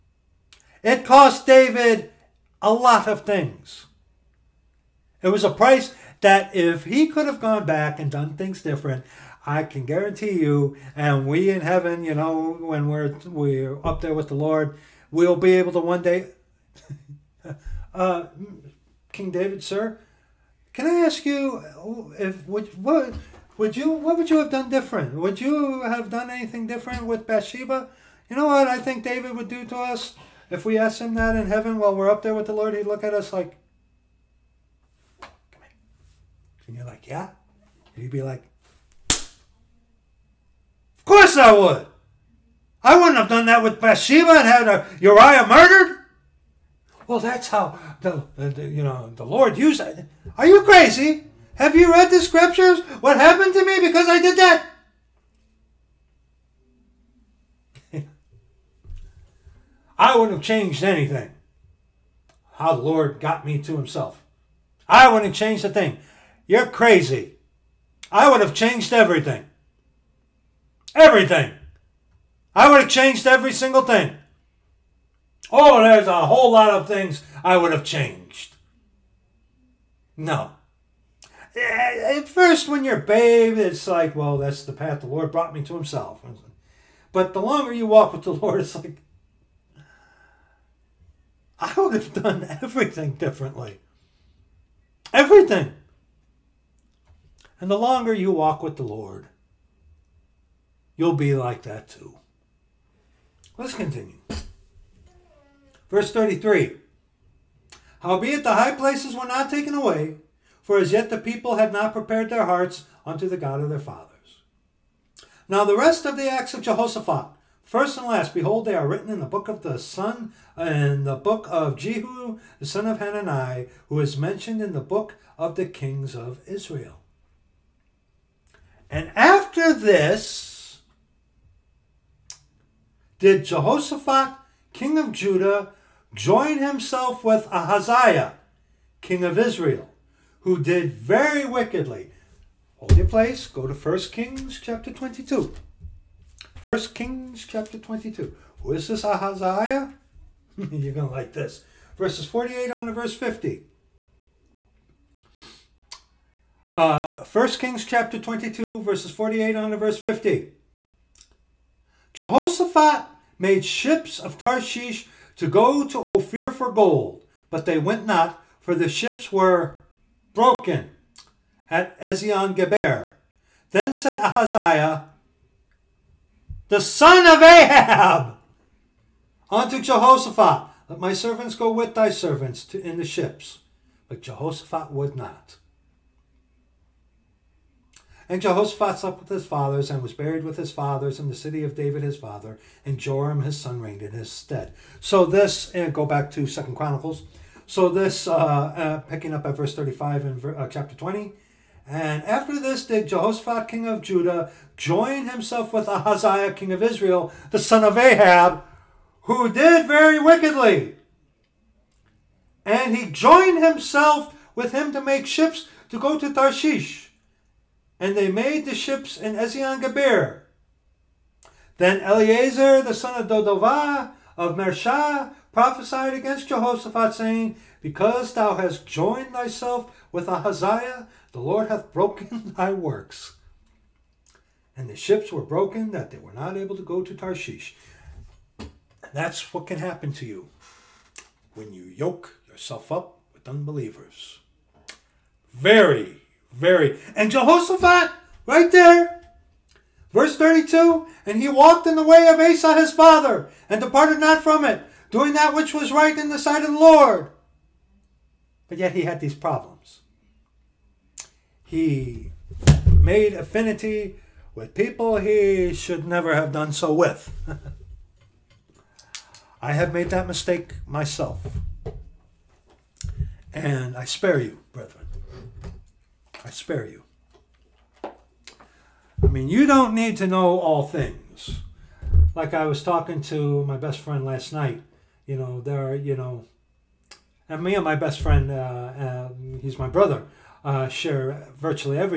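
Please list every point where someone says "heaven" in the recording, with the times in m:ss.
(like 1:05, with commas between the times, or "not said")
0:11, 0:31.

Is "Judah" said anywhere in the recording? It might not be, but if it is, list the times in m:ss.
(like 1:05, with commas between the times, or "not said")
2:15, 3:24.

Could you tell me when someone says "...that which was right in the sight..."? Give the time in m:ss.
4:15.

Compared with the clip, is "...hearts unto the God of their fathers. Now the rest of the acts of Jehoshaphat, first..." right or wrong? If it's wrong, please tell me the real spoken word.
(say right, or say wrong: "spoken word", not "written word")
right.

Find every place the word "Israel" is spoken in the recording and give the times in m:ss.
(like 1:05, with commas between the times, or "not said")
2:06, 2:19, 3:26.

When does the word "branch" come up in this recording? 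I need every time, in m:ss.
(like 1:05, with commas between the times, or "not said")
not said.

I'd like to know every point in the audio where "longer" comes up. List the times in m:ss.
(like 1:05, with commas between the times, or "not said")
1:27, 1:37.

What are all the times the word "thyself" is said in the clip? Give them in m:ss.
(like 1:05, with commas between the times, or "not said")
3:49.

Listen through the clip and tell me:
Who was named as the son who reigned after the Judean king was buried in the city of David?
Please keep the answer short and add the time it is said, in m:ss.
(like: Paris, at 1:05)
Joram, at 3:12.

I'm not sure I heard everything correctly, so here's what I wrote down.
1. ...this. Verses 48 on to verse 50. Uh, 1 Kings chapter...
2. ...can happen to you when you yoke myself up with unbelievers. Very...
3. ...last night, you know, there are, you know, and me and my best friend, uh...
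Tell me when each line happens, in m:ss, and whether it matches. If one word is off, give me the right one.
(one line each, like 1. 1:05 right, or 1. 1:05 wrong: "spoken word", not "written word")
1. 2:31 right
2. 3:59 wrong: "yourself", not "myself"
3. 4:44 right.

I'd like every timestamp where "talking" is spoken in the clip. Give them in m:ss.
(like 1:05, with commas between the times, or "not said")
4:42.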